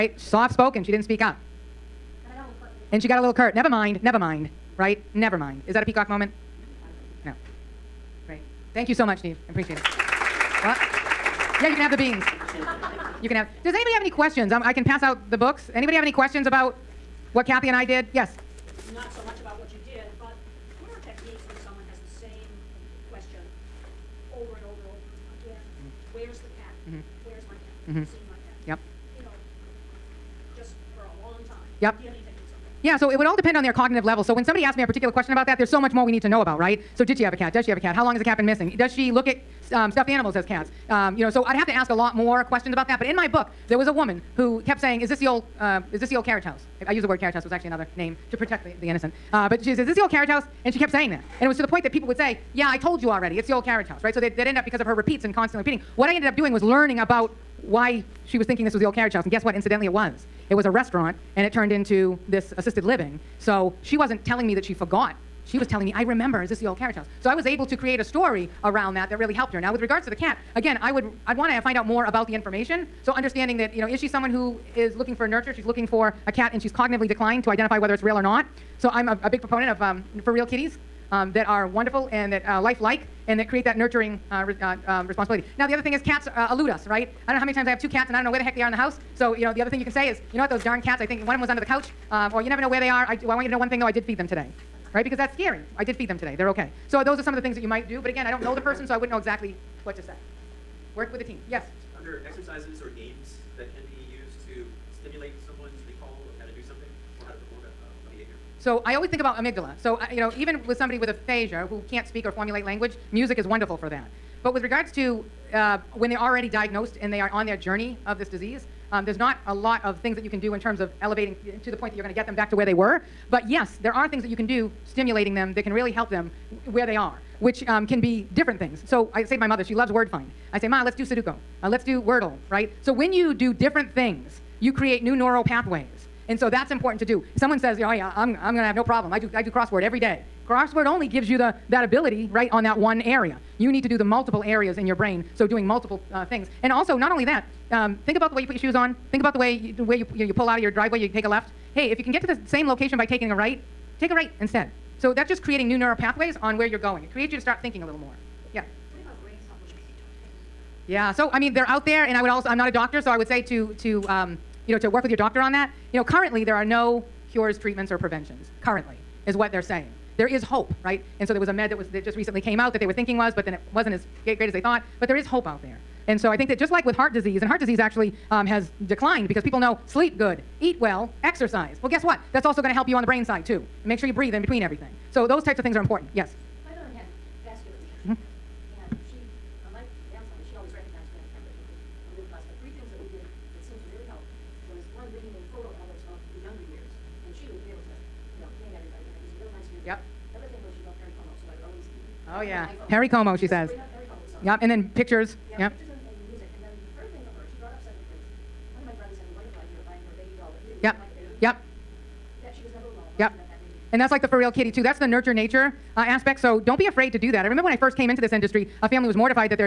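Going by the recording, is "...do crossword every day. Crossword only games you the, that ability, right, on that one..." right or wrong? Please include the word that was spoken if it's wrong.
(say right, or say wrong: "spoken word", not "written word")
wrong: "gives", not "games".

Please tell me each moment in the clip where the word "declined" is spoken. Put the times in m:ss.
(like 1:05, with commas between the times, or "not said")
1:17, 2:58.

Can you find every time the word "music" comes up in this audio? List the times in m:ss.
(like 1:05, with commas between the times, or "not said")
1:53, 3:26.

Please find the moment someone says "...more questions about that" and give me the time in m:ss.
0:42.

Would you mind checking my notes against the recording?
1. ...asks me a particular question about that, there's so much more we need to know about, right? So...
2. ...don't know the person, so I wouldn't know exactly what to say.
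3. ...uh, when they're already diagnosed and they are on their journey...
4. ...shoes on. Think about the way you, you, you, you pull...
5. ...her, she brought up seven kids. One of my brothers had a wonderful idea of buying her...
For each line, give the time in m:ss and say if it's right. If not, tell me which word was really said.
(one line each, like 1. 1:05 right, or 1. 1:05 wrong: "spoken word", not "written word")
1. 0:34 right
2. 1:38 right
3. 1:55 right
4. 2:28 right
5. 3:27 right.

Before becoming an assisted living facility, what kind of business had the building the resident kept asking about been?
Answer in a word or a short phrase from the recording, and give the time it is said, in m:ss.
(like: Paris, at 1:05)
a restaurant, at 1:00.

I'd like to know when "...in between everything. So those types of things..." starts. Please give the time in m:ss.
3:04.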